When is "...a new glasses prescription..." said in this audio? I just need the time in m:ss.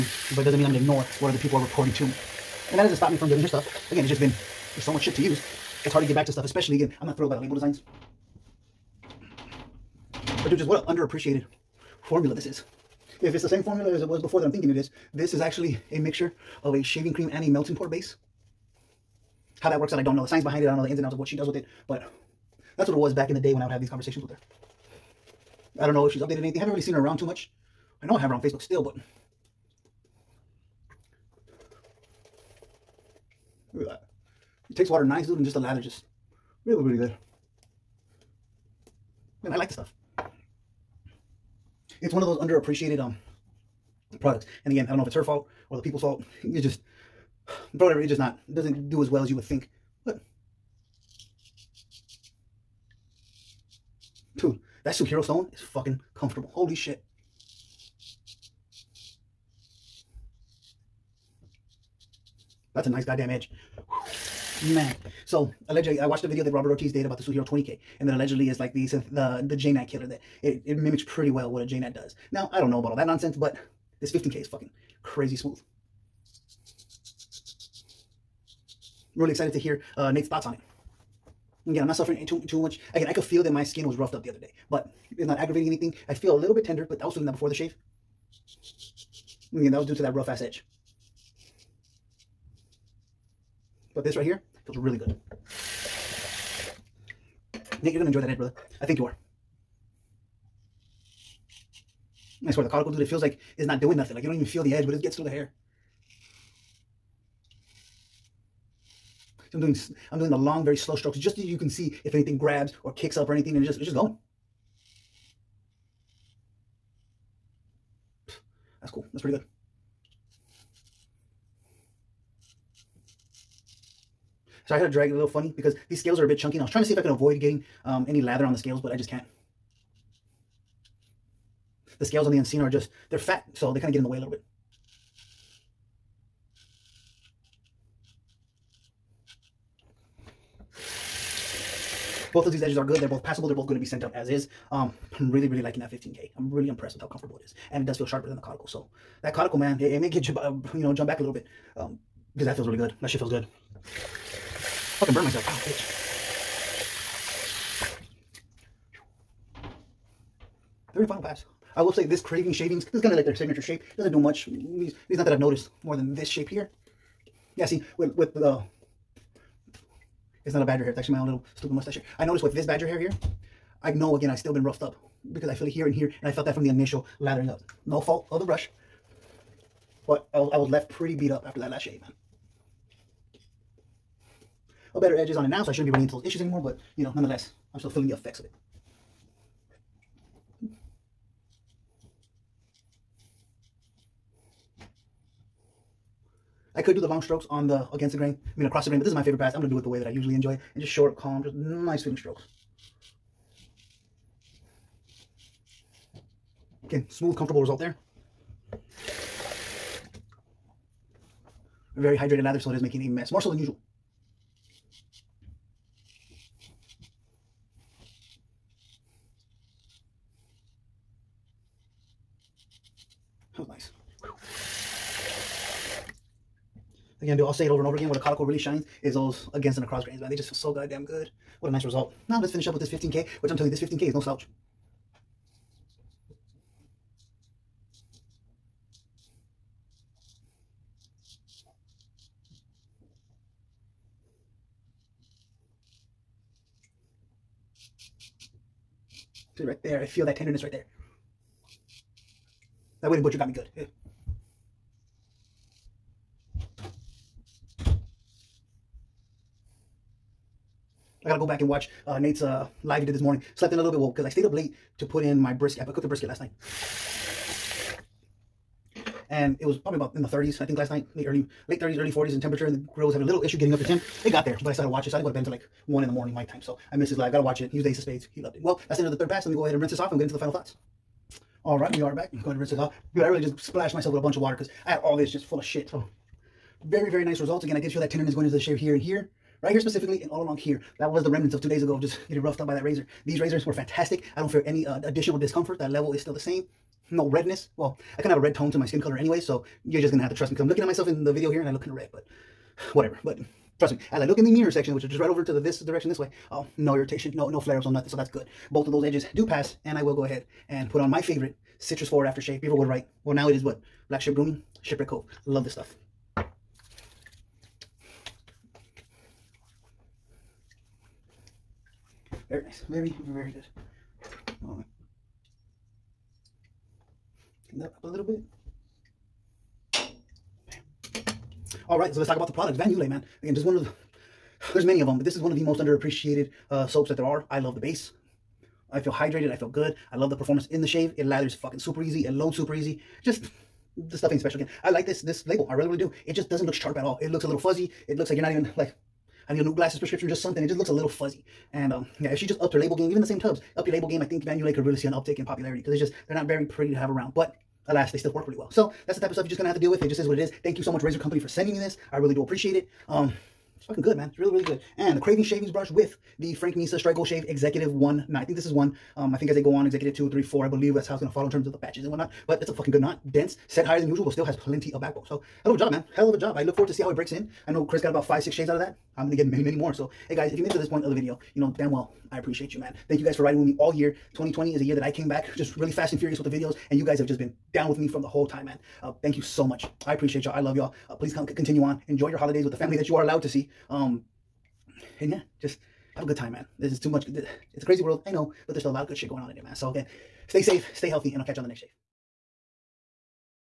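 5:49.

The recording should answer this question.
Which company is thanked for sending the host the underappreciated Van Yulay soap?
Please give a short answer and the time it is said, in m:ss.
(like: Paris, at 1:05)
Razor Company, at 6:01.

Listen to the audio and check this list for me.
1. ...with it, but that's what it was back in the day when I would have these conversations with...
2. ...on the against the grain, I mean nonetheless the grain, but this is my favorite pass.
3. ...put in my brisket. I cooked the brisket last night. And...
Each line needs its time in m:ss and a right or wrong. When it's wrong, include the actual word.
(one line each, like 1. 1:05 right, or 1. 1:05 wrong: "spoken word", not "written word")
1. 0:21 right
2. 3:17 wrong: "across", not "nonetheless"
3. 4:25 right.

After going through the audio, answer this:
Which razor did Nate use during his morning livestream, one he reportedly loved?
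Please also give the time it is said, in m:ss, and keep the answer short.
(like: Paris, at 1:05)
Ace of Spades, at 4:37.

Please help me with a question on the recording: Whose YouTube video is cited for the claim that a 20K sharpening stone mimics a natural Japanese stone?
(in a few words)
Robert Ortiz.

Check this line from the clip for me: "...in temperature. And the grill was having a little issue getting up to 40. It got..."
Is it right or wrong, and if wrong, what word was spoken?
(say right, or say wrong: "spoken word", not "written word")
wrong: "10", not "40".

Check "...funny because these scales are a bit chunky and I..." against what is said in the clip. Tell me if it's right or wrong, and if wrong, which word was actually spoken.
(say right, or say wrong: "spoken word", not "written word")
right.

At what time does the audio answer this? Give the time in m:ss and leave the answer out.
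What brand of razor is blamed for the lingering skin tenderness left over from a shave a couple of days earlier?
4:13.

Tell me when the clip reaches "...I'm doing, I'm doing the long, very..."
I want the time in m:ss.
1:49.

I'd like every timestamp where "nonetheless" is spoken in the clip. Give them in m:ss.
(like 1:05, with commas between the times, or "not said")
3:07.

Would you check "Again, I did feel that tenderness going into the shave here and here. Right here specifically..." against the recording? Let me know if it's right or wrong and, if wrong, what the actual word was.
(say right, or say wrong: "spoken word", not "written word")
right.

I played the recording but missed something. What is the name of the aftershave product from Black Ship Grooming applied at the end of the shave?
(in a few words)
Shipwreck Cove.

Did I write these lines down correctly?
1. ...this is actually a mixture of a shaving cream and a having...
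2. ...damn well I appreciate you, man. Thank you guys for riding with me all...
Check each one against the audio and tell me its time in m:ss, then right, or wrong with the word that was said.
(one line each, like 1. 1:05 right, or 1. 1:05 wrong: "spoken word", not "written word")
1. 0:15 wrong: "melting", not "having"
2. 6:21 right.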